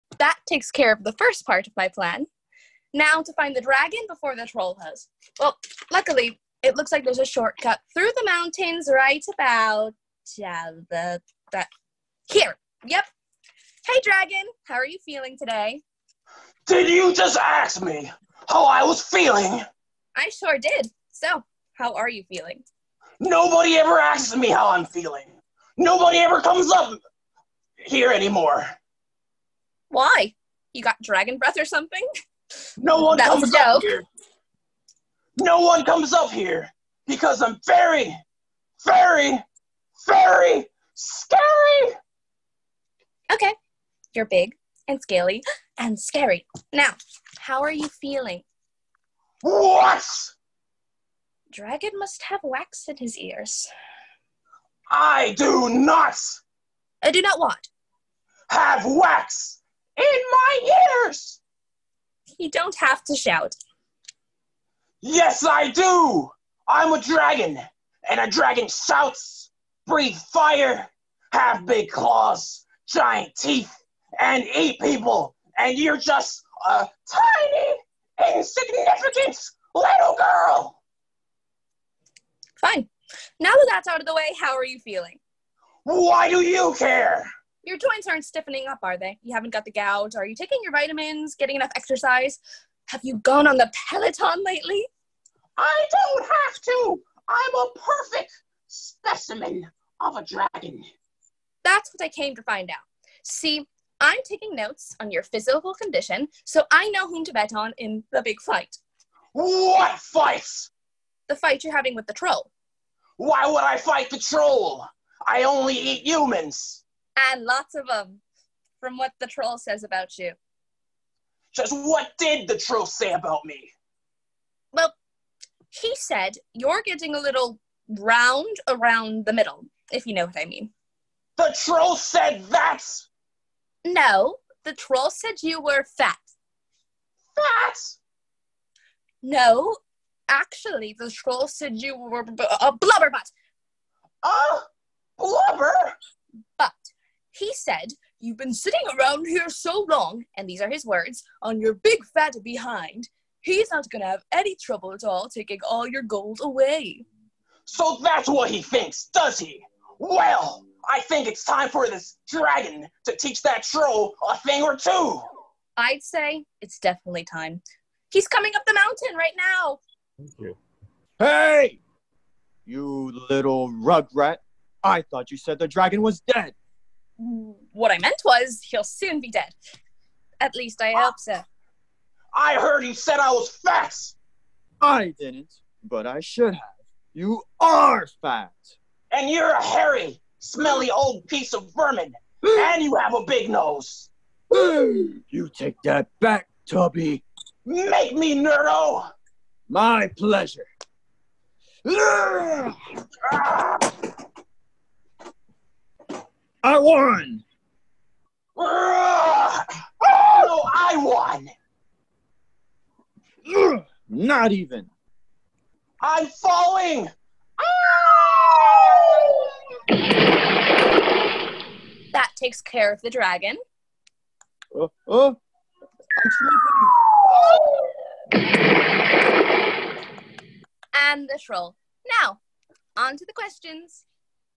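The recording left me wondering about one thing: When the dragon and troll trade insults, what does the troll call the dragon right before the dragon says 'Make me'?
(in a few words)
Tubby.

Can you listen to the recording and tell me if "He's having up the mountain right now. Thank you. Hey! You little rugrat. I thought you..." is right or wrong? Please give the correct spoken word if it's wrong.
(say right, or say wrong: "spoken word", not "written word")
wrong: "coming", not "having".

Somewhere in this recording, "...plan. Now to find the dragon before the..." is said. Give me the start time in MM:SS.
00:01.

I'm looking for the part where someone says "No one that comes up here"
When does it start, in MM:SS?
00:32.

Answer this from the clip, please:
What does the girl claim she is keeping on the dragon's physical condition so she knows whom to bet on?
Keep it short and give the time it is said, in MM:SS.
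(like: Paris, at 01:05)
notes, at 01:44.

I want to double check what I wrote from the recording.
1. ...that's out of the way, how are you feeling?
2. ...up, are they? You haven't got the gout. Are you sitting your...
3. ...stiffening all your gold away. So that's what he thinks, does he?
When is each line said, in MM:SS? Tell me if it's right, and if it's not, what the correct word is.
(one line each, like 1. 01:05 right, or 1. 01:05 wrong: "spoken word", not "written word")
1. 01:23 right
2. 01:28 wrong: "taking", not "sitting"
3. 02:35 wrong: "taking", not "stiffening".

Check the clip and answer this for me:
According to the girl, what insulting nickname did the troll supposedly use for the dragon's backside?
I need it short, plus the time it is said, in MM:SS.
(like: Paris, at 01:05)
blubber butt, at 02:22.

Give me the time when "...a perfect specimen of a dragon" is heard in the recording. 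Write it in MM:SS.
01:37.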